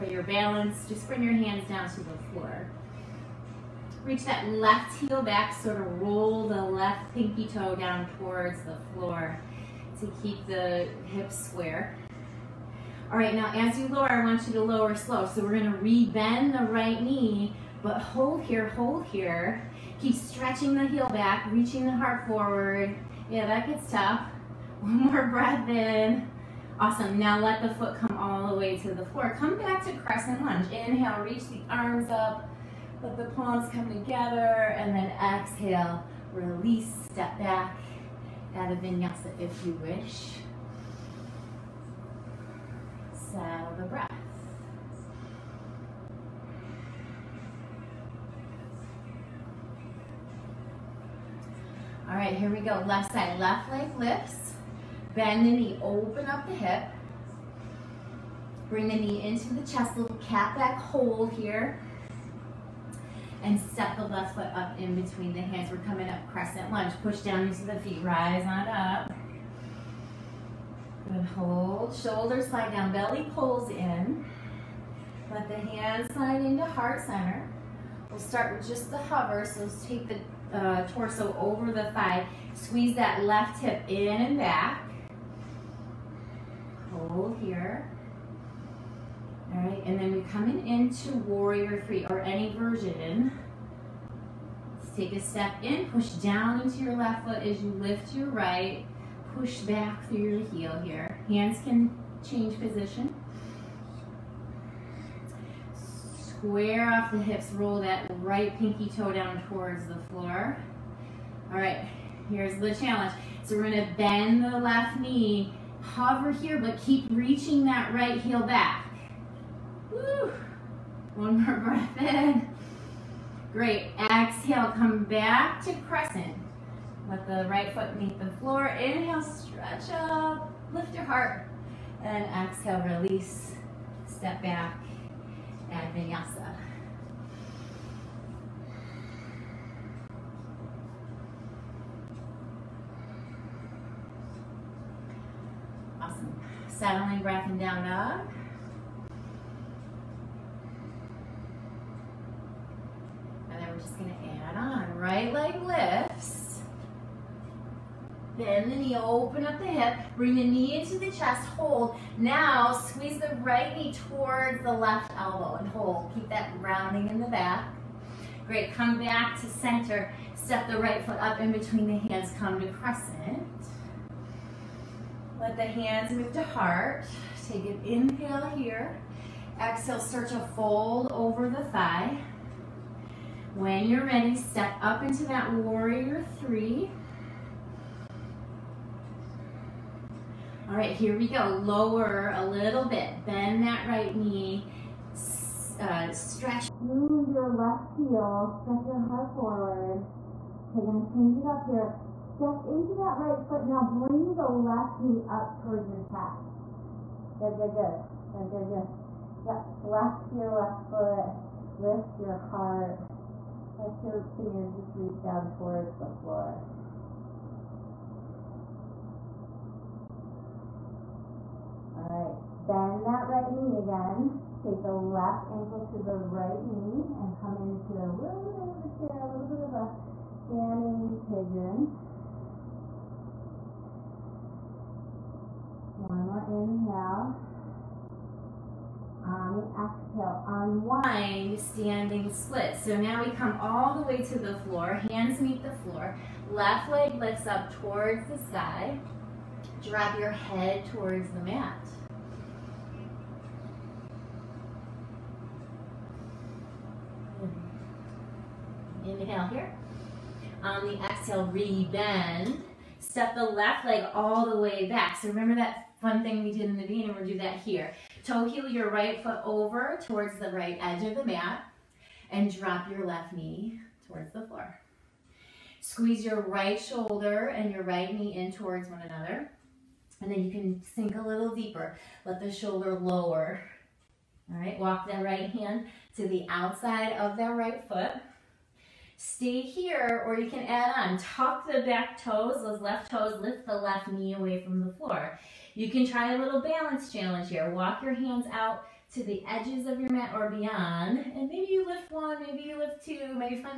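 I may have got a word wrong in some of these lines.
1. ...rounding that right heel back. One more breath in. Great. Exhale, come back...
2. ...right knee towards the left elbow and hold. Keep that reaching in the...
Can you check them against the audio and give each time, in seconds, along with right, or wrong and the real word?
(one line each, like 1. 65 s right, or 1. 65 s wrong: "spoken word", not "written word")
1. 117 s wrong: "reaching", not "rounding"
2. 163 s wrong: "rounding", not "reaching".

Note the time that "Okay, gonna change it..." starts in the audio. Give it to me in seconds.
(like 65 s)
200 s.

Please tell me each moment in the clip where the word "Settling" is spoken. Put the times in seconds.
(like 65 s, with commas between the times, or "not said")
146 s.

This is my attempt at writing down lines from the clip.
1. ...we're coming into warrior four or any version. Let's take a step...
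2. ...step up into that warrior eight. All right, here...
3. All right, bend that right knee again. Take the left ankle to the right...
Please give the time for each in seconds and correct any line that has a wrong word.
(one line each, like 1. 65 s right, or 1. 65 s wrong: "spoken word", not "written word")
1. 90 s wrong: "three", not "four"
2. 184 s wrong: "three", not "eight"
3. 221 s right.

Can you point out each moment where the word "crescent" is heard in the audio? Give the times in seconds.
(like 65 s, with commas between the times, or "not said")
29 s, 66 s, 125 s, 172 s.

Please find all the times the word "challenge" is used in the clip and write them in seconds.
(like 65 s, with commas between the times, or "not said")
112 s, 297 s.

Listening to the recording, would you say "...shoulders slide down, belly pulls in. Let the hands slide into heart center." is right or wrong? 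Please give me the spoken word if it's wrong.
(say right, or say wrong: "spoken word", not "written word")
right.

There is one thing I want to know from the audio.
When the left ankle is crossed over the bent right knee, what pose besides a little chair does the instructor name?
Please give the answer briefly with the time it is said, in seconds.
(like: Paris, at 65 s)
standing pigeon, at 230 s.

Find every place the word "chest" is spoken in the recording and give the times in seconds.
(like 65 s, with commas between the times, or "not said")
59 s, 161 s, 206 s.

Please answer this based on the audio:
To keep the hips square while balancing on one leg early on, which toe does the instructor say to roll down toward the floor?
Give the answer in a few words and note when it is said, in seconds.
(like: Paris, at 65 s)
left pinky toe, at 6 s.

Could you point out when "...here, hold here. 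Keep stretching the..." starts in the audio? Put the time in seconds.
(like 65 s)
18 s.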